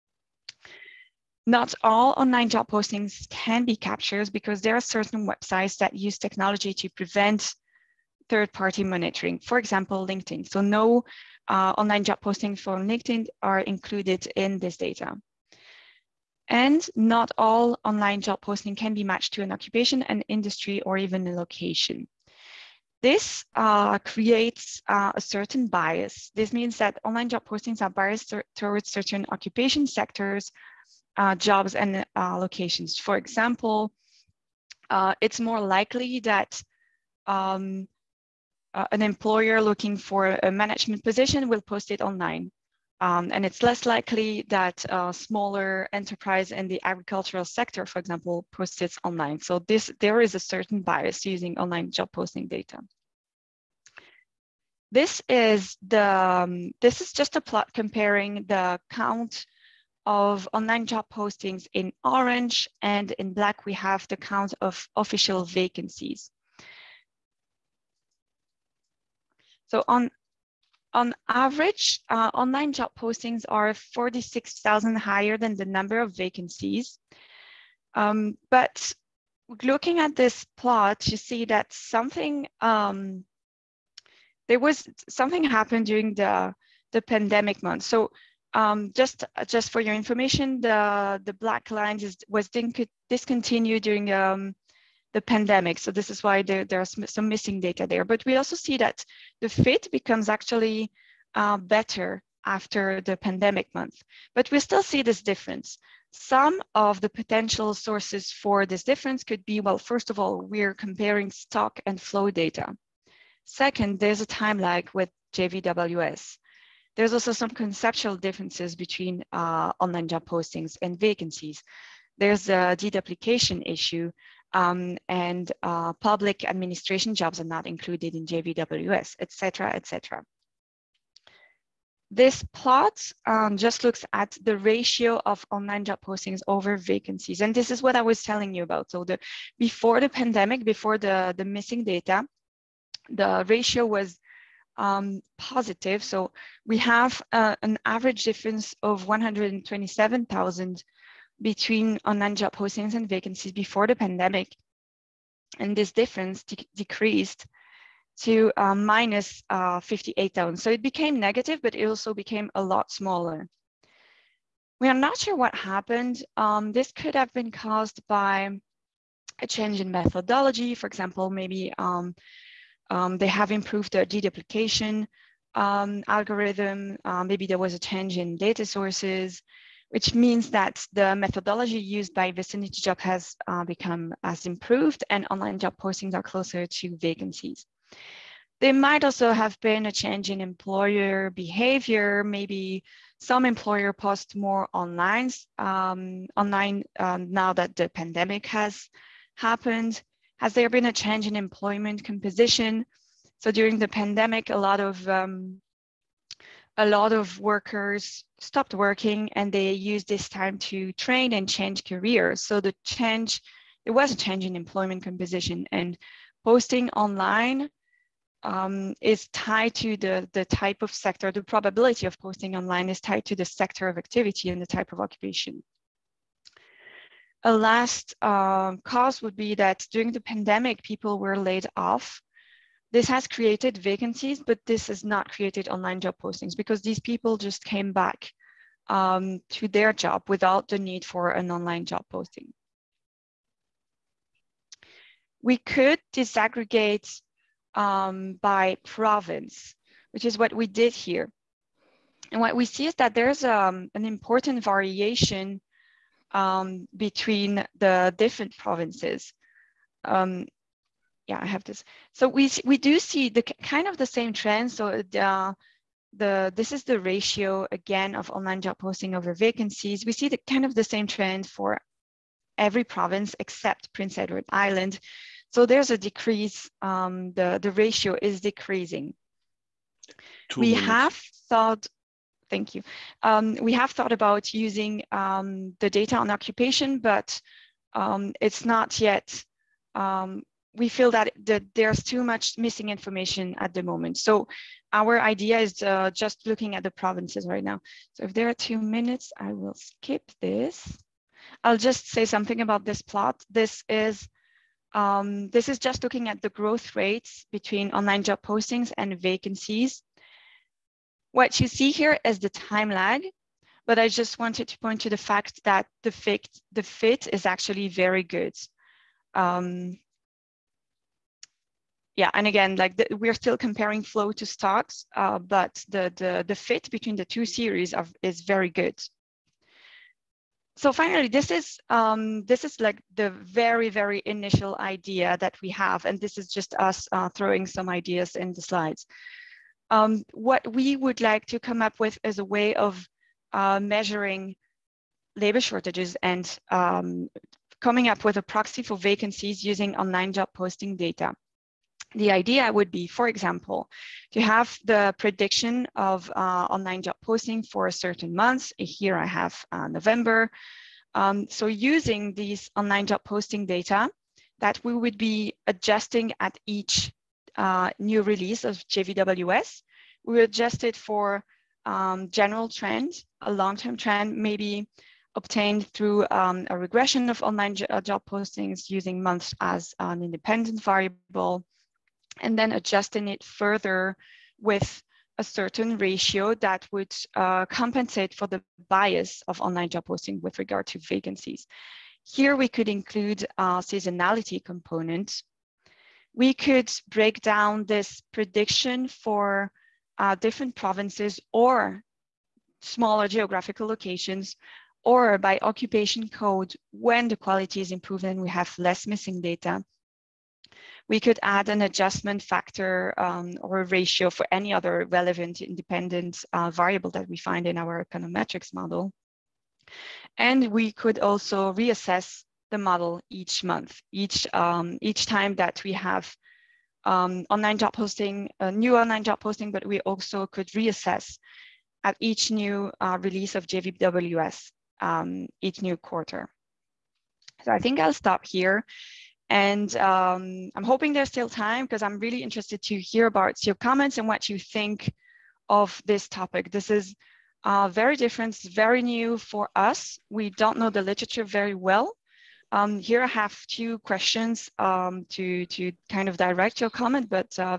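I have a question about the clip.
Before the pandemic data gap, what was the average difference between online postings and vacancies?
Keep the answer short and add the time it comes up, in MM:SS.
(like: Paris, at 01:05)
127,000, at 02:29.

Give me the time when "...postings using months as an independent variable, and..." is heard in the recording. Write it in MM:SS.
06:18.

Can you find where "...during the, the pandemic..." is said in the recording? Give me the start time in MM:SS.
01:25.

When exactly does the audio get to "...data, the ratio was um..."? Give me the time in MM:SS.
02:21.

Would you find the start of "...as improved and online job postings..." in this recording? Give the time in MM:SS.
03:04.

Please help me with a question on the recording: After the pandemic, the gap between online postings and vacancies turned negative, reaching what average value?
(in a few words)
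-58,000.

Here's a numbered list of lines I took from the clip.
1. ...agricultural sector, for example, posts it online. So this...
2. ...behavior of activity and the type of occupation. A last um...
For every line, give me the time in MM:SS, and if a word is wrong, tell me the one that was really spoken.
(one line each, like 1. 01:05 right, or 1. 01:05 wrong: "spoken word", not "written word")
1. 00:46 right
2. 03:43 wrong: "sector", not "behavior".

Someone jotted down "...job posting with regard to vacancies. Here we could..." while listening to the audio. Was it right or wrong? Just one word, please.
right.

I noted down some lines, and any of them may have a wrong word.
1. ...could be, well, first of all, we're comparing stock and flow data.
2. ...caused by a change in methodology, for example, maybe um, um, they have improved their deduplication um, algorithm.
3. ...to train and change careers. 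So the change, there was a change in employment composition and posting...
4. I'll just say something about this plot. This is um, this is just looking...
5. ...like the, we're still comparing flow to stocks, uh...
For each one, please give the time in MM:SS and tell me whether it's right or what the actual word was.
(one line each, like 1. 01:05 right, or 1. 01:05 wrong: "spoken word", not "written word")
1. 01:49 right
2. 02:47 right
3. 03:30 right
4. 05:01 right
5. 05:22 right.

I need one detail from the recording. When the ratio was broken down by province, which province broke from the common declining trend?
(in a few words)
Prince Edward Island.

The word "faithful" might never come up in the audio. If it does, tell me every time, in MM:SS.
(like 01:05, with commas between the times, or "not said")
not said.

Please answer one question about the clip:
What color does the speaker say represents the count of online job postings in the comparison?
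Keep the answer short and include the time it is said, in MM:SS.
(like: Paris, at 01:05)
orange, at 01:02.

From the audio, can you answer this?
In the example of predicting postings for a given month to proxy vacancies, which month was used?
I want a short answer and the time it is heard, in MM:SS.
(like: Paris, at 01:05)
November, at 05:59.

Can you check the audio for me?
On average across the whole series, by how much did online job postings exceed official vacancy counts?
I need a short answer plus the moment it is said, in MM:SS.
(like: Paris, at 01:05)
46,000, at 01:13.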